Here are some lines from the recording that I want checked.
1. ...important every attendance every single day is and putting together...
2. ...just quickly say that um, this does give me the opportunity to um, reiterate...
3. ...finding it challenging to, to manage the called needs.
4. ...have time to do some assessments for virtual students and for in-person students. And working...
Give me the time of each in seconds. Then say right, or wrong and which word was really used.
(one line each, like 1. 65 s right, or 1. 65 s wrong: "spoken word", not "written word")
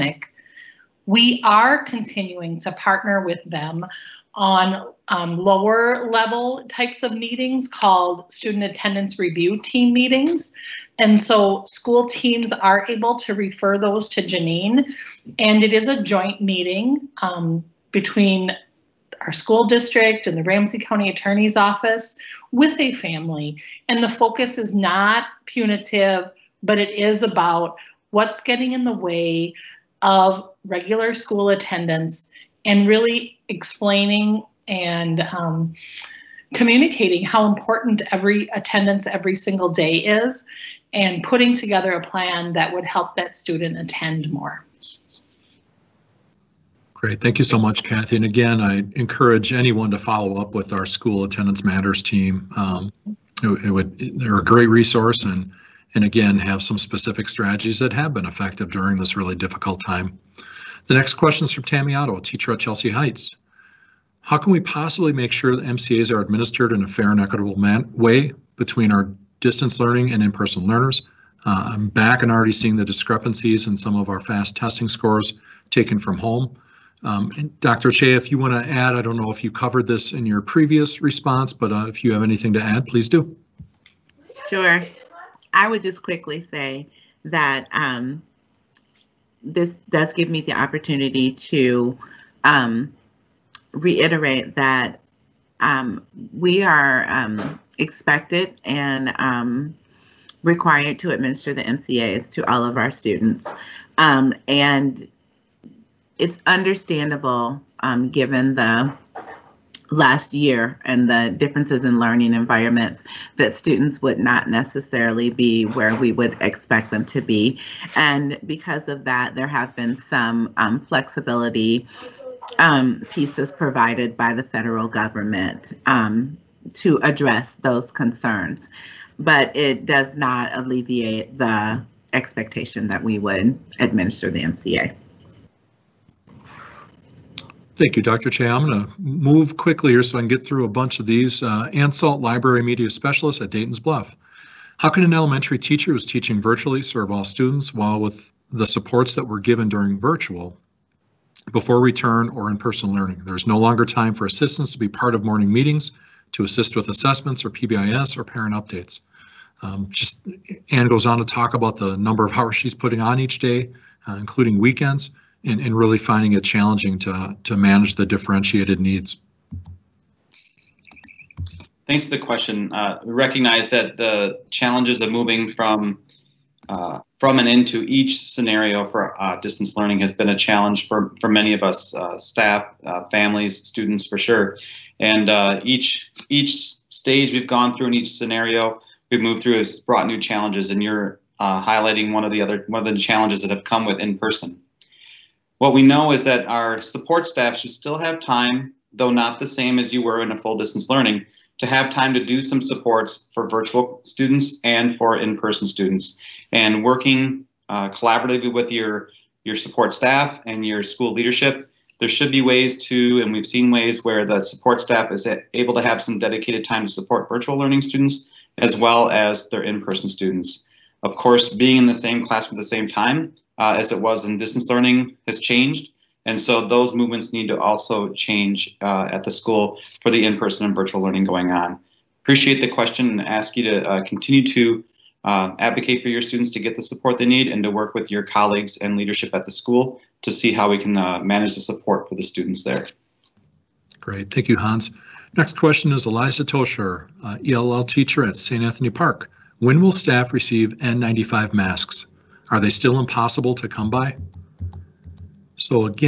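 1. 37 s right
2. 85 s right
3. 165 s wrong: "differentiated", not "called"
4. 201 s wrong: "supports", not "assessments".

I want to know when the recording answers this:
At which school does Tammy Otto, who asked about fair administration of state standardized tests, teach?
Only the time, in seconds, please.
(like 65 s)
62 s.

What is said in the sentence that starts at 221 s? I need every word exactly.
Of course, being in the same classroom at the same time uh, as it was in distance learning has changed.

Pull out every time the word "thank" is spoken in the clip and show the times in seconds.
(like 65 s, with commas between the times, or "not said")
47 s, 137 s, 171 s, 244 s.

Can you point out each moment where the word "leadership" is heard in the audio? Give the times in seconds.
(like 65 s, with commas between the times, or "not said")
211 s, 238 s.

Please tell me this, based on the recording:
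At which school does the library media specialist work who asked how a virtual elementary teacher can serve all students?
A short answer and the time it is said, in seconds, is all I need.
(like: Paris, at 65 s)
Dayton's Bluff, at 143 s.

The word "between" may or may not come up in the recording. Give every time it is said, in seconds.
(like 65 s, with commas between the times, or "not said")
17 s, 68 s.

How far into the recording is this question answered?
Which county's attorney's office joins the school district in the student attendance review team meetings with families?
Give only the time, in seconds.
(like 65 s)
20 s.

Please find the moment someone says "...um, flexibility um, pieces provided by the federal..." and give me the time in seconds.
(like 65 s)
120 s.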